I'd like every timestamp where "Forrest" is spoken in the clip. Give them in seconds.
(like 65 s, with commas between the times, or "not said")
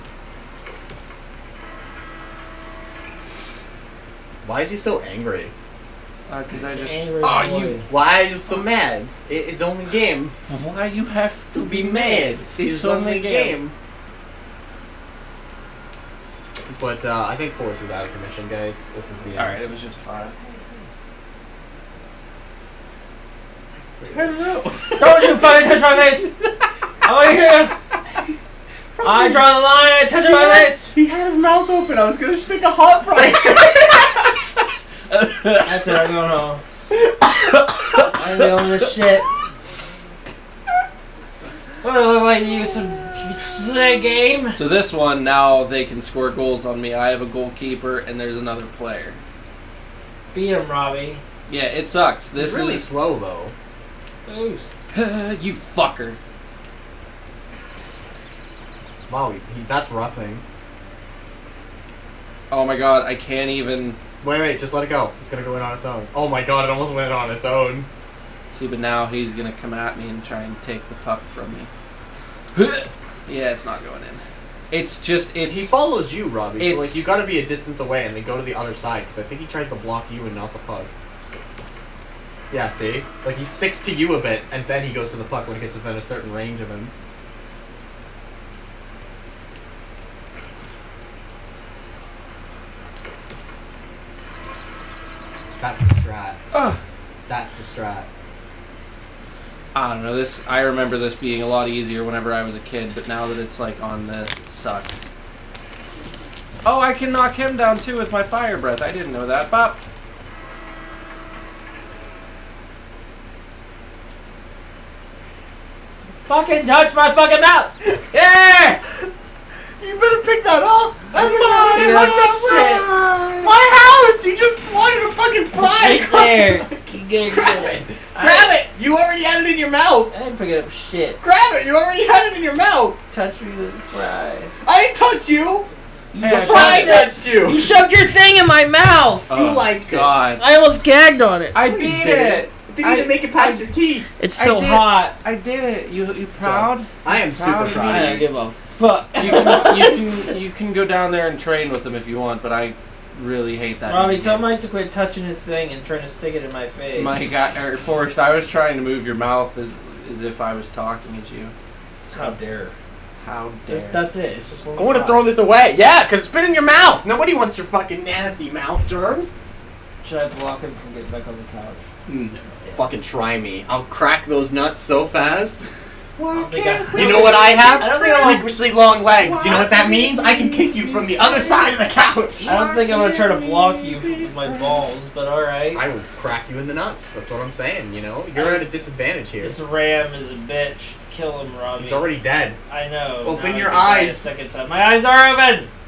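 157 s.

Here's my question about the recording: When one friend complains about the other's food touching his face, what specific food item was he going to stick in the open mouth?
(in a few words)
hot fry.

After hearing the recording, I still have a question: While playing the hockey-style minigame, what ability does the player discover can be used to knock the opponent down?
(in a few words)
fire breath.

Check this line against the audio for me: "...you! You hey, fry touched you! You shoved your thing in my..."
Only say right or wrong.
right.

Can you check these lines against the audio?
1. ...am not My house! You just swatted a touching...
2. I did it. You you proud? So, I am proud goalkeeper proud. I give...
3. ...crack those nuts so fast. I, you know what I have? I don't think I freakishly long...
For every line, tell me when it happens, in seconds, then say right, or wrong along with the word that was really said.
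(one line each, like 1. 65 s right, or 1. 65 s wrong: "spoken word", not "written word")
1. 121 s wrong: "fucking", not "touching"
2. 145 s wrong: "super", not "goalkeeper"
3. 173 s right.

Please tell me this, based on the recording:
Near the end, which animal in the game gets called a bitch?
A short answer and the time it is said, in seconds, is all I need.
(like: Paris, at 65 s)
ram, at 189 s.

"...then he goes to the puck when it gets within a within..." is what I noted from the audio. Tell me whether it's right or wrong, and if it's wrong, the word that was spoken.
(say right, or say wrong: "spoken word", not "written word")
wrong: "certain", not "within".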